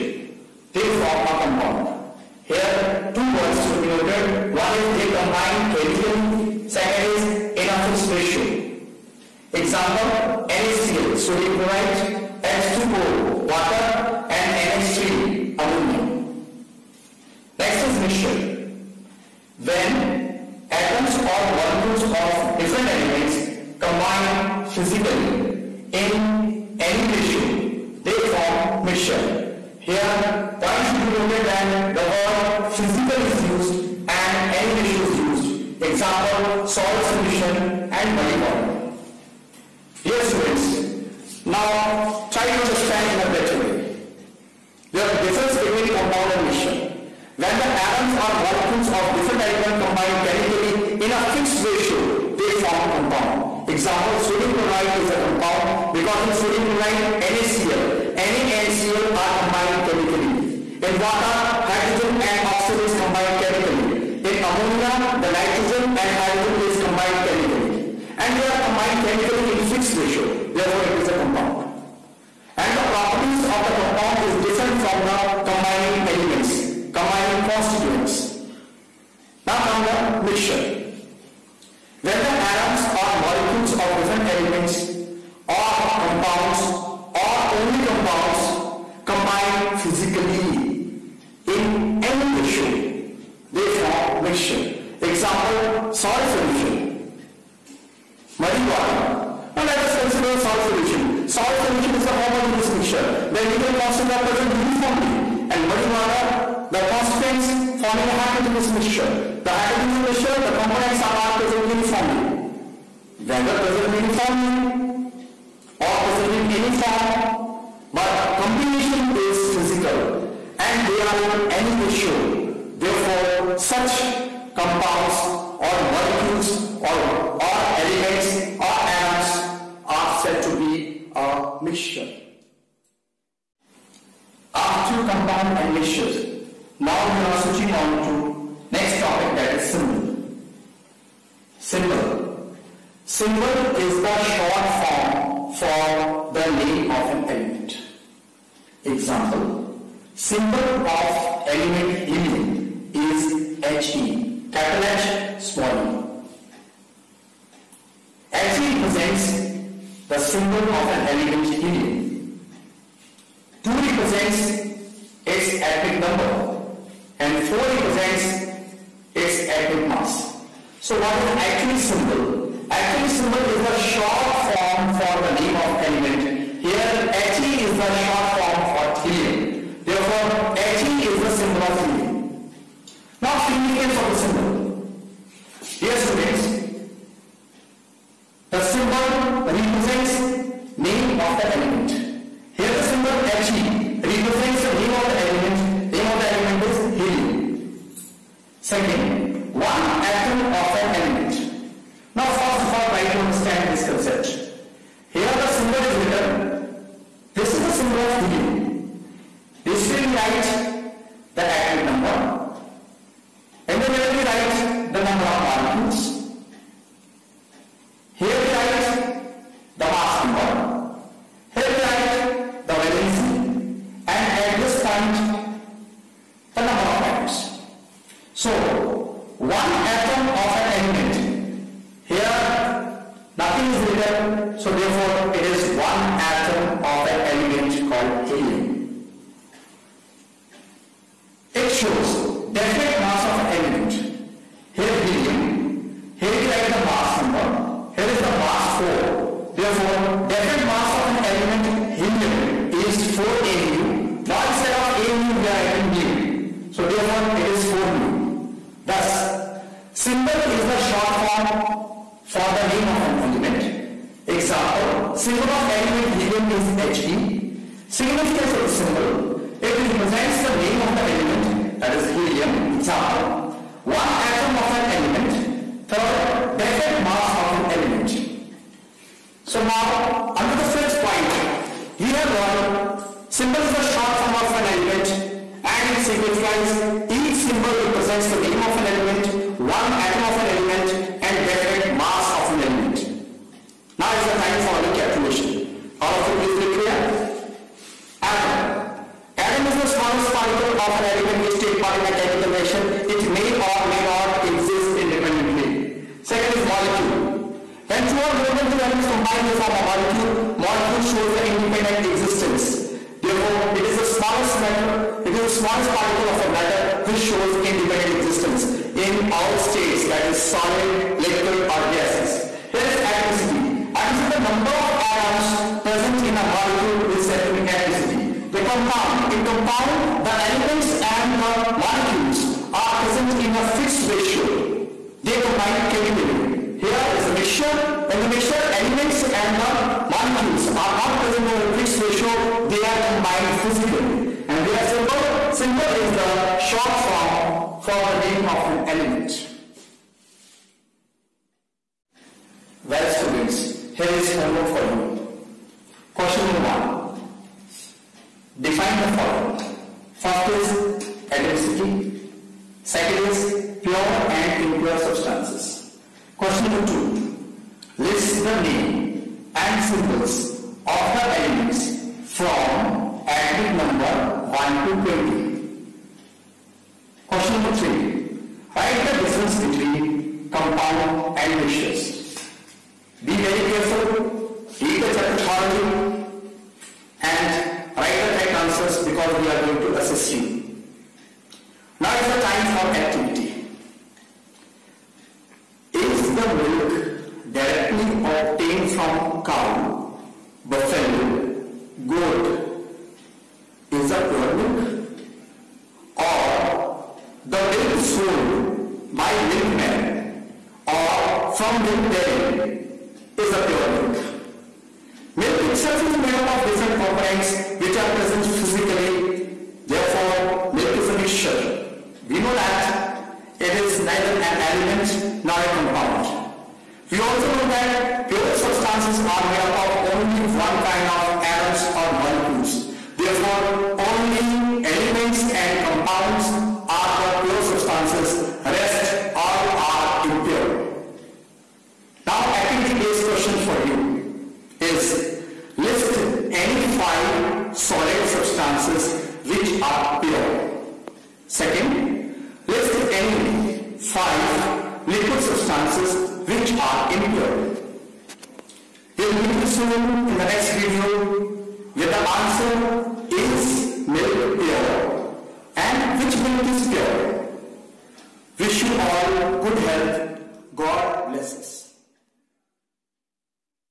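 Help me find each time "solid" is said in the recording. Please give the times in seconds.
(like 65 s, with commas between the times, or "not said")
320 s, 447 s.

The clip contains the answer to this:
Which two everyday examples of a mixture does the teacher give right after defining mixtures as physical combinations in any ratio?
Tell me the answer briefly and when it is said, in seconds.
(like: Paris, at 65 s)
Salt solution and muddy water, at 36 s.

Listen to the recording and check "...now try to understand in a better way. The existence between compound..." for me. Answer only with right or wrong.
wrong.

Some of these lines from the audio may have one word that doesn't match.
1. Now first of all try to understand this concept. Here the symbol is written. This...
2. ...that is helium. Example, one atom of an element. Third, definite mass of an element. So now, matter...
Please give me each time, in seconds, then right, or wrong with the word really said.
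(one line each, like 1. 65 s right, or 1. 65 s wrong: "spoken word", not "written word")
1. 202 s right
2. 271 s wrong: "under", not "matter".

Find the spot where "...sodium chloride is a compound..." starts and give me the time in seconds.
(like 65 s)
54 s.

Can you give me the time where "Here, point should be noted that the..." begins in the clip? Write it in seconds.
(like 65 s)
29 s.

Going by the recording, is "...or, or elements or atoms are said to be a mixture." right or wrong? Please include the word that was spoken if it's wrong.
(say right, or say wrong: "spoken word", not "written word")
right.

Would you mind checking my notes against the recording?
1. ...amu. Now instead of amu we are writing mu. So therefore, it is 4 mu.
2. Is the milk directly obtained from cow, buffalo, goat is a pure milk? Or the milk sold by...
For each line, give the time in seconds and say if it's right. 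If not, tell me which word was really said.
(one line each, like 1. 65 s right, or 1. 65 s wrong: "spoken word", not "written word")
1. 253 s right
2. 395 s right.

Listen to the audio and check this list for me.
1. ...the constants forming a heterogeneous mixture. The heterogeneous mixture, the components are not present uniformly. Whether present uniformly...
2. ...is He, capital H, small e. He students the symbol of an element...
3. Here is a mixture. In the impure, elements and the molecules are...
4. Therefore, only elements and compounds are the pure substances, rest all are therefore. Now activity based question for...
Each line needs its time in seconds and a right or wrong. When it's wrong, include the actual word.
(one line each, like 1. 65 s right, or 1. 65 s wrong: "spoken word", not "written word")
1. 106 s right
2. 152 s wrong: "represents", not "students"
3. 336 s wrong: "mixture", not "impure"
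4. 433 s wrong: "impure", not "therefore".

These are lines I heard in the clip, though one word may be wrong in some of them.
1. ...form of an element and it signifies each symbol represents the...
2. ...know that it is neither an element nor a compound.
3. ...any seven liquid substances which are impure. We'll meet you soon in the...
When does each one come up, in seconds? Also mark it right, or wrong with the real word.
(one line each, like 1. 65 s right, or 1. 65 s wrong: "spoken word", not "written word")
1. 284 s right
2. 422 s right
3. 453 s wrong: "five", not "seven".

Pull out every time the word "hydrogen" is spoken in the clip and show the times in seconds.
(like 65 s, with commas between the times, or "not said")
61 s, 66 s.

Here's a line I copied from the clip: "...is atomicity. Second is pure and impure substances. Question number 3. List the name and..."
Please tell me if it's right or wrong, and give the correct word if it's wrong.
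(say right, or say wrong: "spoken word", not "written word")
wrong: "2", not "3".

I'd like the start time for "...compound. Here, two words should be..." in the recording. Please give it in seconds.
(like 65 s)
1 s.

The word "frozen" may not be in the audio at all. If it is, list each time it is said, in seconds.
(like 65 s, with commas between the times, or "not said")
not said.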